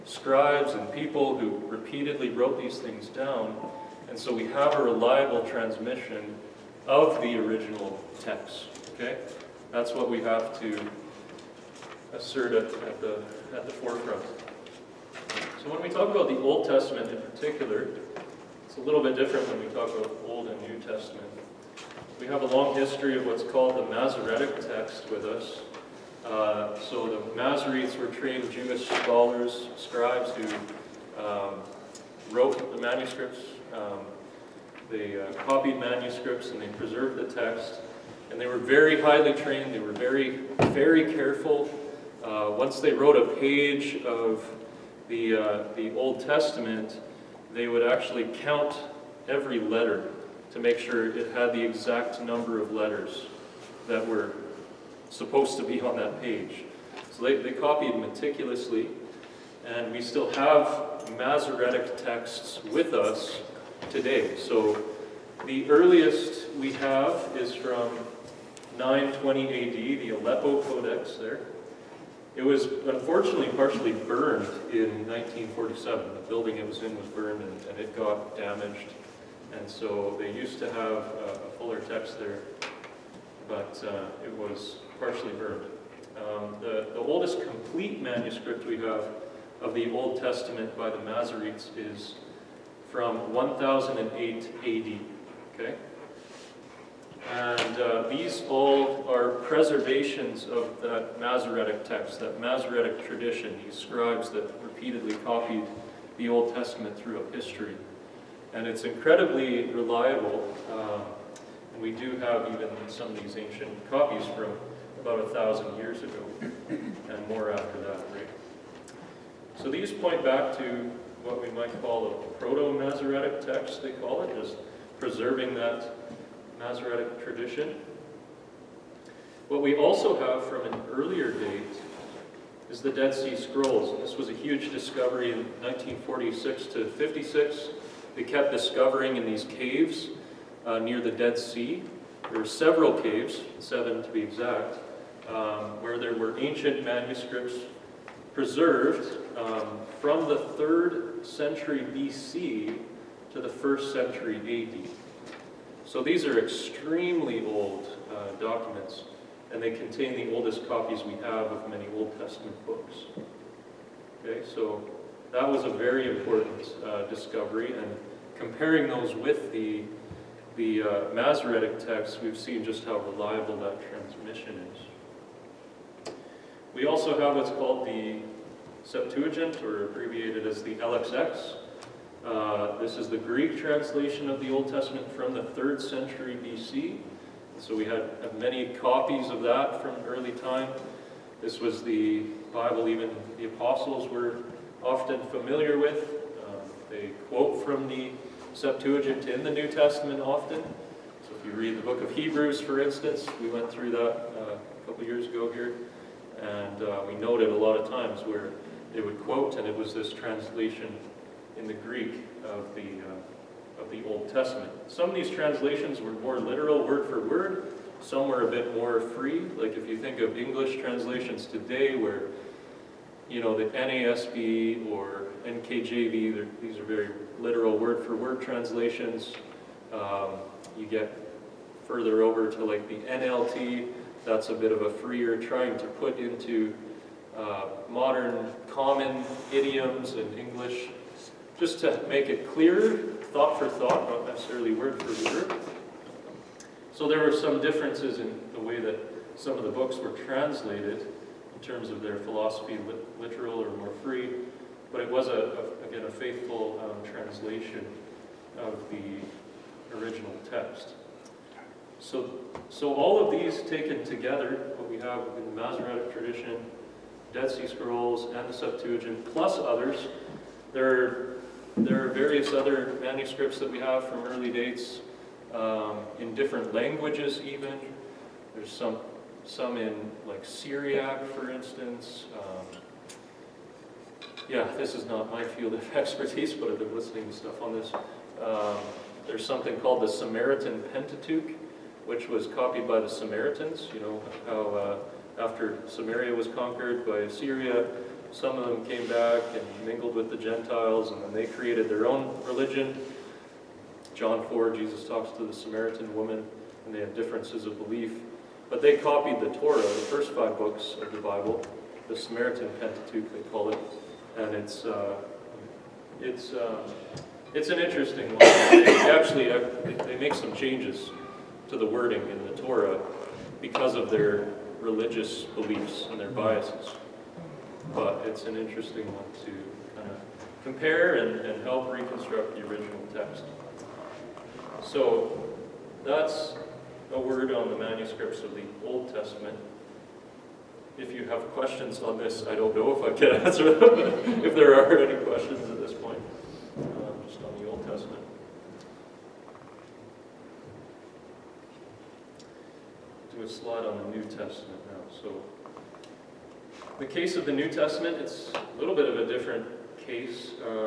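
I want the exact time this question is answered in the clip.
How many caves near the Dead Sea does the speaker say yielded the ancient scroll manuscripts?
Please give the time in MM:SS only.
02:23.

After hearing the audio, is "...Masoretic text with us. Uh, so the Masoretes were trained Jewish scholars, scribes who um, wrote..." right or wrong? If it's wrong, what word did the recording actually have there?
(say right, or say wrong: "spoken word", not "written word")
right.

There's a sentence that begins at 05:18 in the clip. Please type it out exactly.
They actually uh, they make some changes to the wording in the Torah because of their religious beliefs and their biases.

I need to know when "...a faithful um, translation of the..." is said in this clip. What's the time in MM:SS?
04:16.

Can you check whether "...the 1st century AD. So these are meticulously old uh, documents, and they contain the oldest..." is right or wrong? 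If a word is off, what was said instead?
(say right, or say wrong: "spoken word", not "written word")
wrong: "extremely", not "meticulously".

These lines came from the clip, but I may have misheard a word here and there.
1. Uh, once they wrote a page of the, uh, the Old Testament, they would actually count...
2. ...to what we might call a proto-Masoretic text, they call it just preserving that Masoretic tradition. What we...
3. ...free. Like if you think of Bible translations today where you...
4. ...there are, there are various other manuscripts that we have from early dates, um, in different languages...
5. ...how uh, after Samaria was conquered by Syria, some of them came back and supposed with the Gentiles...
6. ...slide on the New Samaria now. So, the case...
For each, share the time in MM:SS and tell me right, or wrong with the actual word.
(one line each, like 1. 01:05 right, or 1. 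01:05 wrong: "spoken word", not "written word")
1. 00:42 right
2. 02:00 right
3. 03:38 wrong: "English", not "Bible"
4. 04:30 right
5. 04:54 wrong: "mingled", not "supposed"
6. 05:53 wrong: "Testament", not "Samaria".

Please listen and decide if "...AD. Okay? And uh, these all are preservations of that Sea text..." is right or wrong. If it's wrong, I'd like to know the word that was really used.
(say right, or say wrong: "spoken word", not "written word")
wrong: "Masoretic", not "Sea".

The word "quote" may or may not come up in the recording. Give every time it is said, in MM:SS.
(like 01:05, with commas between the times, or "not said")
03:17, 03:29.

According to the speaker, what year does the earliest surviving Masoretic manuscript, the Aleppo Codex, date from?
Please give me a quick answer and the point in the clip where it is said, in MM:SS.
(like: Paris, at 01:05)
920 AD, at 01:08.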